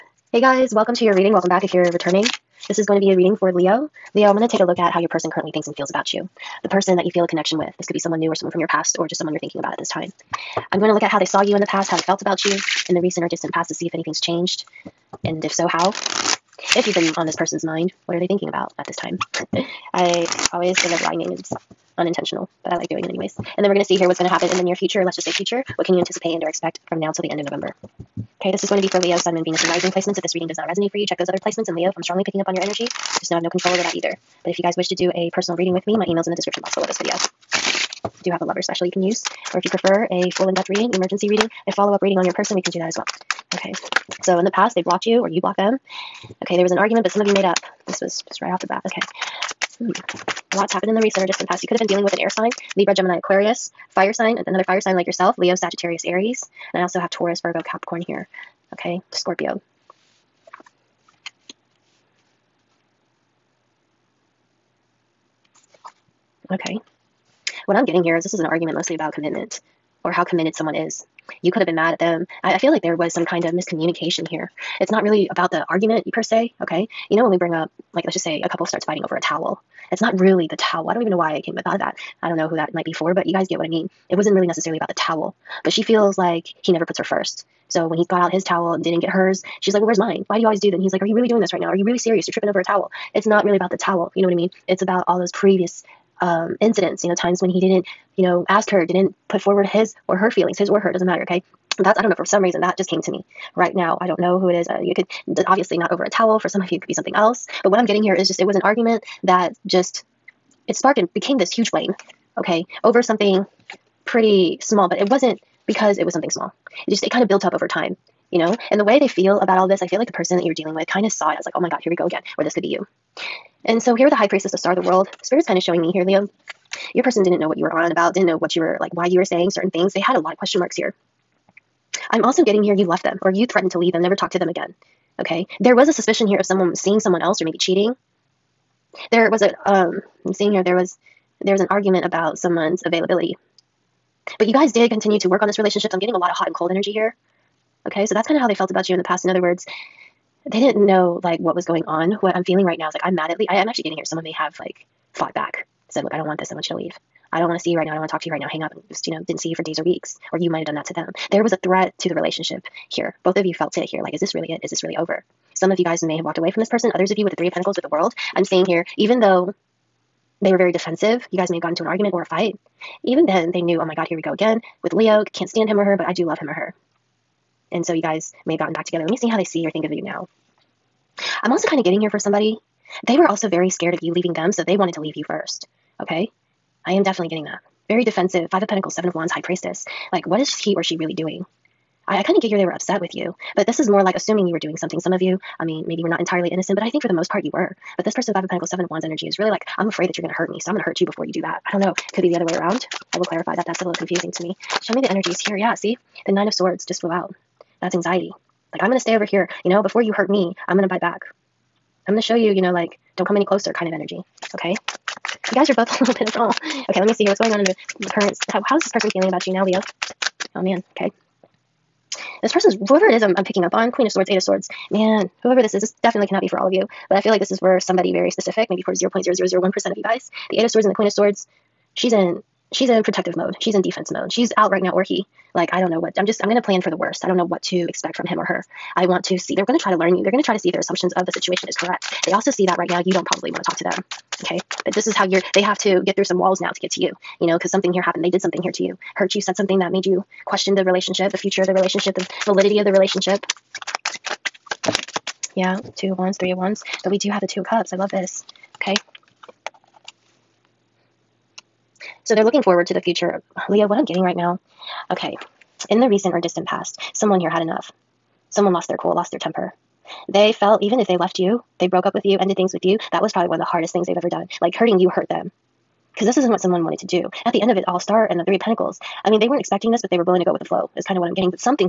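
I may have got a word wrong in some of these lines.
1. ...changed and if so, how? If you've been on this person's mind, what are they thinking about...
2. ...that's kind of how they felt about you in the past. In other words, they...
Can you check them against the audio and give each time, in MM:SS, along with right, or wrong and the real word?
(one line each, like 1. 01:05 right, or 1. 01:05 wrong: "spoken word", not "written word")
1. 00:14 right
2. 02:28 right.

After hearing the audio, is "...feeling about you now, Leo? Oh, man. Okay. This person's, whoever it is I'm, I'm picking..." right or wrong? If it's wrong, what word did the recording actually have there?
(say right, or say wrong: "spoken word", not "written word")
right.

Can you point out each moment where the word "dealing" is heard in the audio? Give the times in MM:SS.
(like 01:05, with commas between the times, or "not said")
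00:51, 02:00.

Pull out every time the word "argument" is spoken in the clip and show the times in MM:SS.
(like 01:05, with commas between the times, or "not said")
00:46, 01:08, 01:15, 01:48, 02:21, 02:51.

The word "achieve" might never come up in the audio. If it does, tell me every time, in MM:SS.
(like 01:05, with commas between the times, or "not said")
not said.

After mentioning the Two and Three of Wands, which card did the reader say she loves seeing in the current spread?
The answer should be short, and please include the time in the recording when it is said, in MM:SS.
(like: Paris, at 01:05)
Two of Cups, at 04:17.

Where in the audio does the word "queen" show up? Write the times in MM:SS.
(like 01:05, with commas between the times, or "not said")
03:43, 03:50.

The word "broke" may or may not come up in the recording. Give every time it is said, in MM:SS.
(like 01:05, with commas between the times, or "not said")
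04:31.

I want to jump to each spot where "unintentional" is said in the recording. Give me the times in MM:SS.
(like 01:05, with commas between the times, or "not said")
00:21.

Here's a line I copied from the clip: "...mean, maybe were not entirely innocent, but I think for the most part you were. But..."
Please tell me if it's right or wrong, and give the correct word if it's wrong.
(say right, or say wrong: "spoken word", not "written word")
right.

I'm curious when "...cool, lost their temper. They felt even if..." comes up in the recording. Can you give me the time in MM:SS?
04:28.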